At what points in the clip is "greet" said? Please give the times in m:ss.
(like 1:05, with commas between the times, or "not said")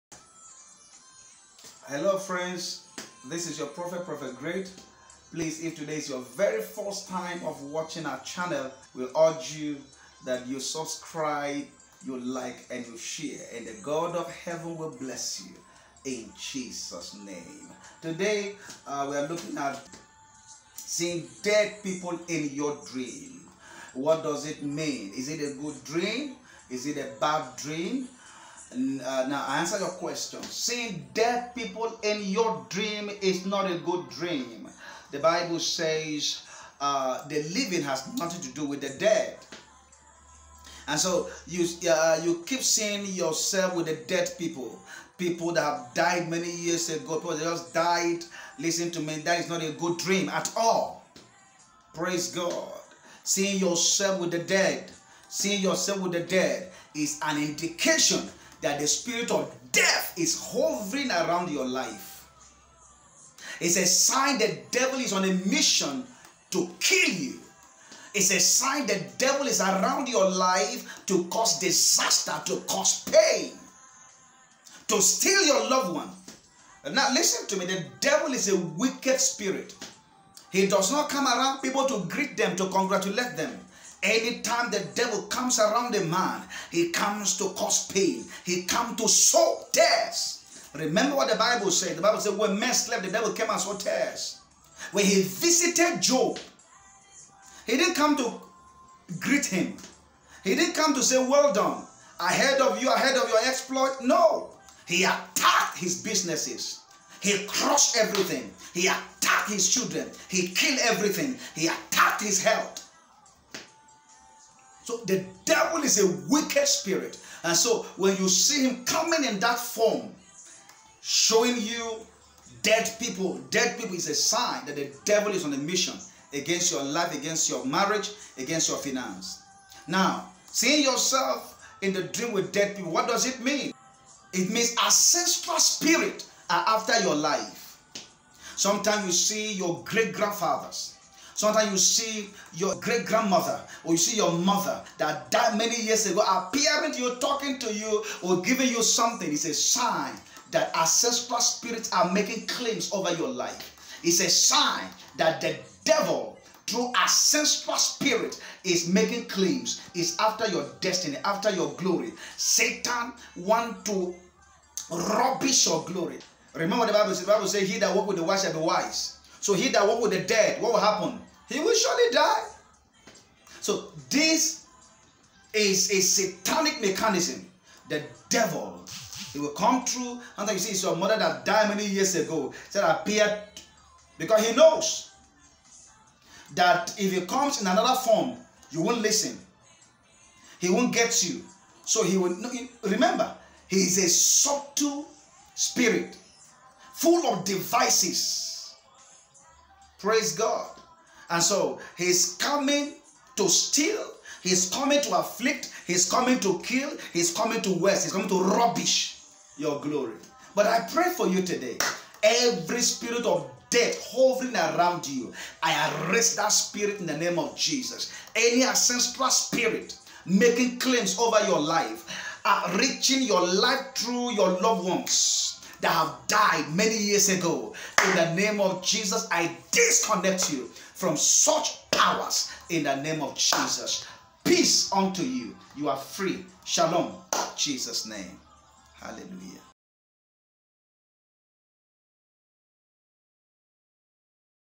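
1:22, 1:39.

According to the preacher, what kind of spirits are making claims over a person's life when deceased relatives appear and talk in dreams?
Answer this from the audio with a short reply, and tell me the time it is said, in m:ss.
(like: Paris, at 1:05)
Ancestral spirits, at 2:30.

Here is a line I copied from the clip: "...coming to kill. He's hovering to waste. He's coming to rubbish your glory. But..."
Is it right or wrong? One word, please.
wrong.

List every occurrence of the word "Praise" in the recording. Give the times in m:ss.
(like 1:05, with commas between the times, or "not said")
0:51, 3:20.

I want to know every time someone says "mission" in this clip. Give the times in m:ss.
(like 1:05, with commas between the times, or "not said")
1:05, 2:05.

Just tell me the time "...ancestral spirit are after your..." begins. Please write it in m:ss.
2:14.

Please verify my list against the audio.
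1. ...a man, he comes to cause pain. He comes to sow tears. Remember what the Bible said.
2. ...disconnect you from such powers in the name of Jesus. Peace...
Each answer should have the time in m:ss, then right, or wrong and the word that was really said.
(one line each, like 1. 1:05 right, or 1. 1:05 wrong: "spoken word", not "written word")
1. 1:25 right
2. 3:49 right.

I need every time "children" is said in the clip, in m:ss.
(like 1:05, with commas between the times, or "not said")
1:49.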